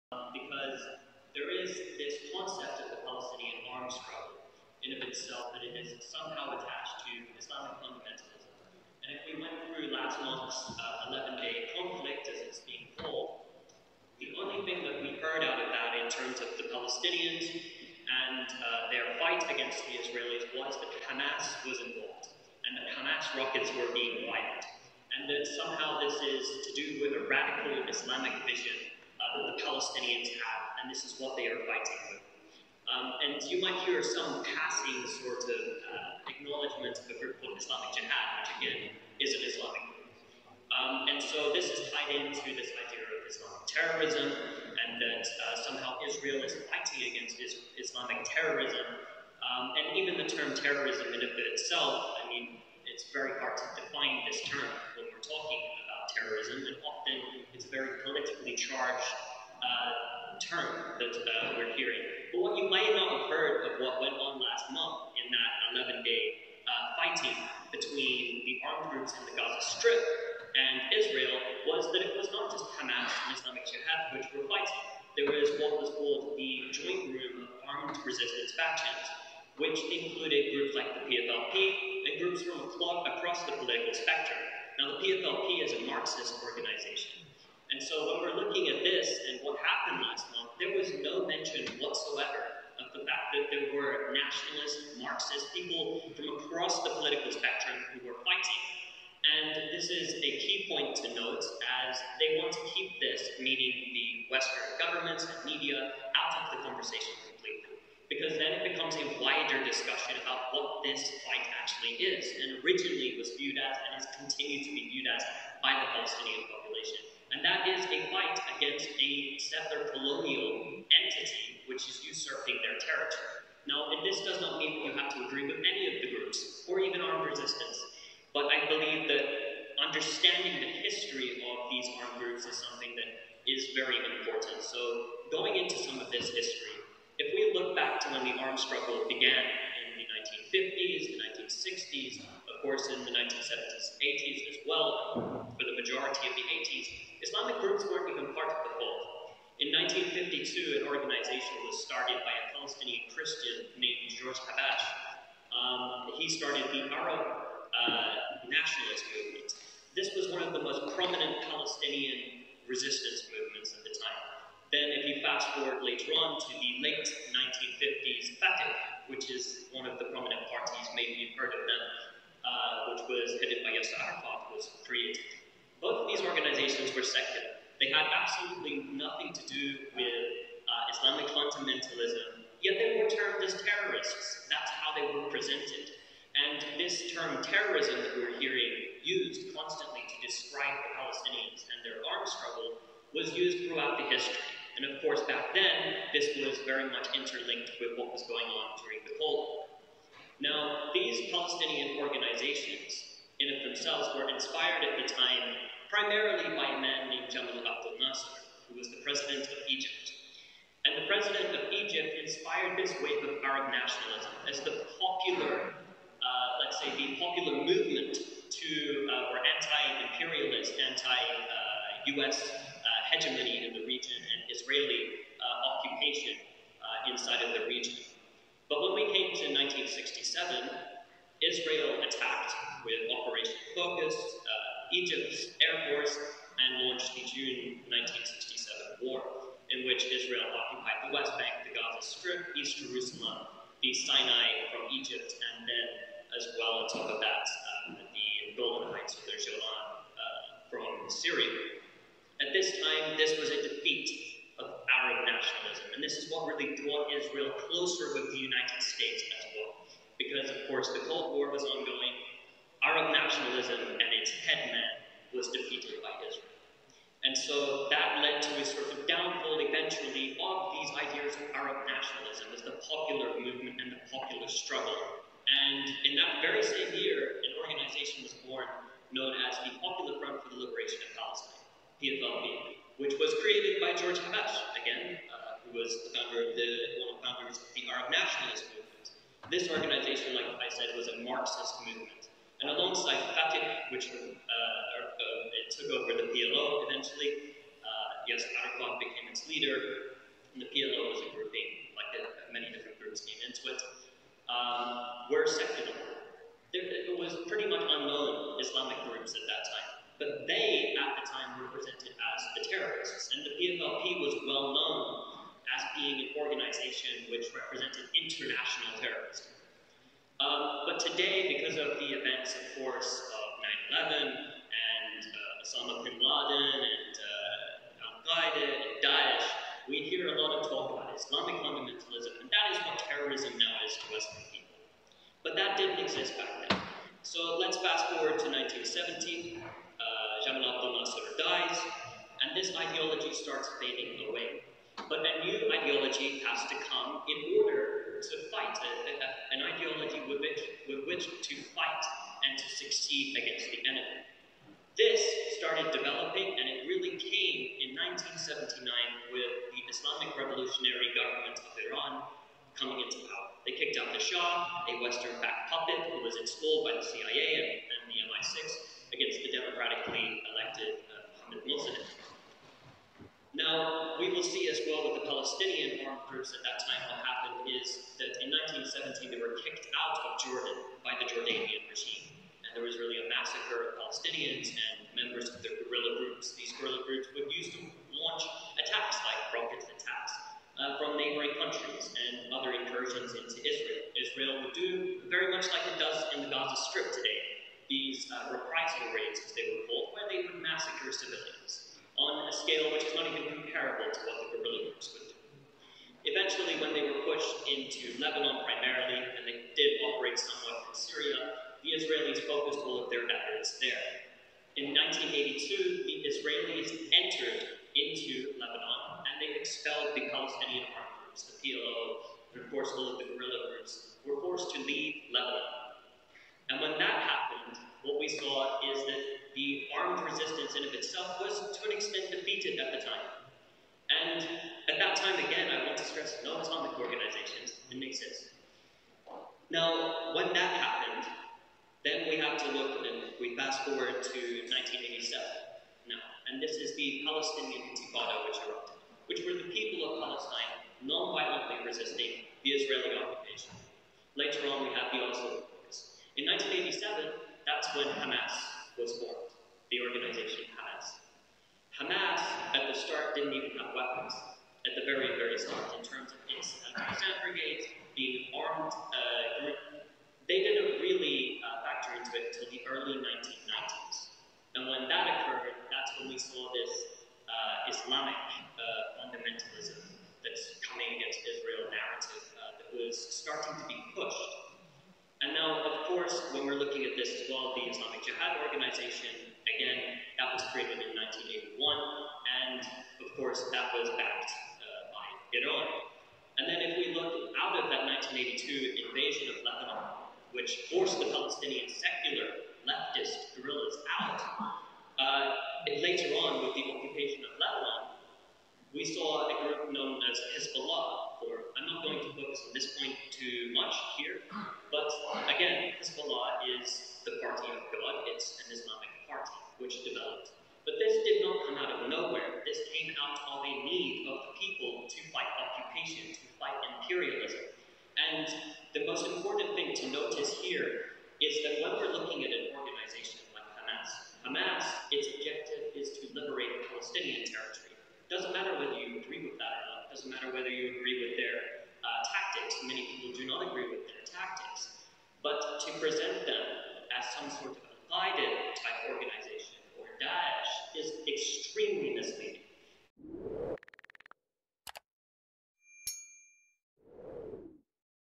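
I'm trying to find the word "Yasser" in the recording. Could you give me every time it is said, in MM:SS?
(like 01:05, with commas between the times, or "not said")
02:53, 04:58.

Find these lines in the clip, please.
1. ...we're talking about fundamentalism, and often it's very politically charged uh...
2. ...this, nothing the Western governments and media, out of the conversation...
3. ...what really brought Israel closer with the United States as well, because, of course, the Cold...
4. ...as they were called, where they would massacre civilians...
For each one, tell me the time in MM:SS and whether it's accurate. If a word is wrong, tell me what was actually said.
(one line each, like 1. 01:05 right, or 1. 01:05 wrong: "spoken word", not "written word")
1. 00:55 wrong: "terrorism", not "fundamentalism"
2. 01:42 wrong: "meaning", not "nothing"
3. 04:16 right
4. 06:39 right.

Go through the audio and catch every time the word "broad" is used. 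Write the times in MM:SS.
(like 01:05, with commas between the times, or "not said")
not said.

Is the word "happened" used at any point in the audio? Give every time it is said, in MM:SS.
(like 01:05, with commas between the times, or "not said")
01:29, 06:17, 07:07, 07:20.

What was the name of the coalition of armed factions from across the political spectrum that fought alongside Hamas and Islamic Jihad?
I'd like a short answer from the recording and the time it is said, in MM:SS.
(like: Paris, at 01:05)
Joint Room of Armed Resistance Factions, at 01:16.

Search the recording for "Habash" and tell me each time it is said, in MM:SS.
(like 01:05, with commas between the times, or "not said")
02:34, 04:44.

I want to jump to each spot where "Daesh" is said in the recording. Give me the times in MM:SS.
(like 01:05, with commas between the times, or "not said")
05:29, 09:10.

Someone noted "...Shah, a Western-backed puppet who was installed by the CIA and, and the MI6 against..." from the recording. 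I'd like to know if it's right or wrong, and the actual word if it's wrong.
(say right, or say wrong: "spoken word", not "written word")
right.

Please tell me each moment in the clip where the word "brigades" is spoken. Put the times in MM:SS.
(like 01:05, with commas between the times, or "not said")
07:47.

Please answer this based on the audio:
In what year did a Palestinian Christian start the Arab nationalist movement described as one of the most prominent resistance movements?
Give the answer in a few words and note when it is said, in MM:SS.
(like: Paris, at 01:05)
1952, at 02:29.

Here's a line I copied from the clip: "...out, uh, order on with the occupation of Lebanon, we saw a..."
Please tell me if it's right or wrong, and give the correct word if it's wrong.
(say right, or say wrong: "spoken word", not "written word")
wrong: "later", not "order".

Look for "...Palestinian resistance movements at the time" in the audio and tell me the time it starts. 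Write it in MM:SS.
02:41.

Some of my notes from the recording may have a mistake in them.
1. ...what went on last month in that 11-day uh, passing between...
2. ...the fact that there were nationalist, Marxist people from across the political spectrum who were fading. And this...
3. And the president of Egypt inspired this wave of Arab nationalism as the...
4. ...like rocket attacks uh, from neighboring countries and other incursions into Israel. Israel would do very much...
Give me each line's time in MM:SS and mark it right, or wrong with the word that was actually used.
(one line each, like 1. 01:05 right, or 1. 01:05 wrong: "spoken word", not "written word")
1. 01:03 wrong: "fighting", not "passing"
2. 01:32 wrong: "fighting", not "fading"
3. 03:30 right
4. 06:29 right.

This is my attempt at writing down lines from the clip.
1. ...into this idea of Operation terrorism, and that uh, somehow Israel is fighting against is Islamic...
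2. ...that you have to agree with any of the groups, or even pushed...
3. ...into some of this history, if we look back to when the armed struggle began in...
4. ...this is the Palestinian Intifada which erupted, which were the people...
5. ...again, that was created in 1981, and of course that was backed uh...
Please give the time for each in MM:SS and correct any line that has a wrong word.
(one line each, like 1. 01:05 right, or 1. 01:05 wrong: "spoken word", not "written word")
1. 00:42 wrong: "Islamic", not "Operation"
2. 02:04 wrong: "armed", not "pushed"
3. 02:15 right
4. 07:26 right
5. 08:09 right.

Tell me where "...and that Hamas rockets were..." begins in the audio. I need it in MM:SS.
00:22.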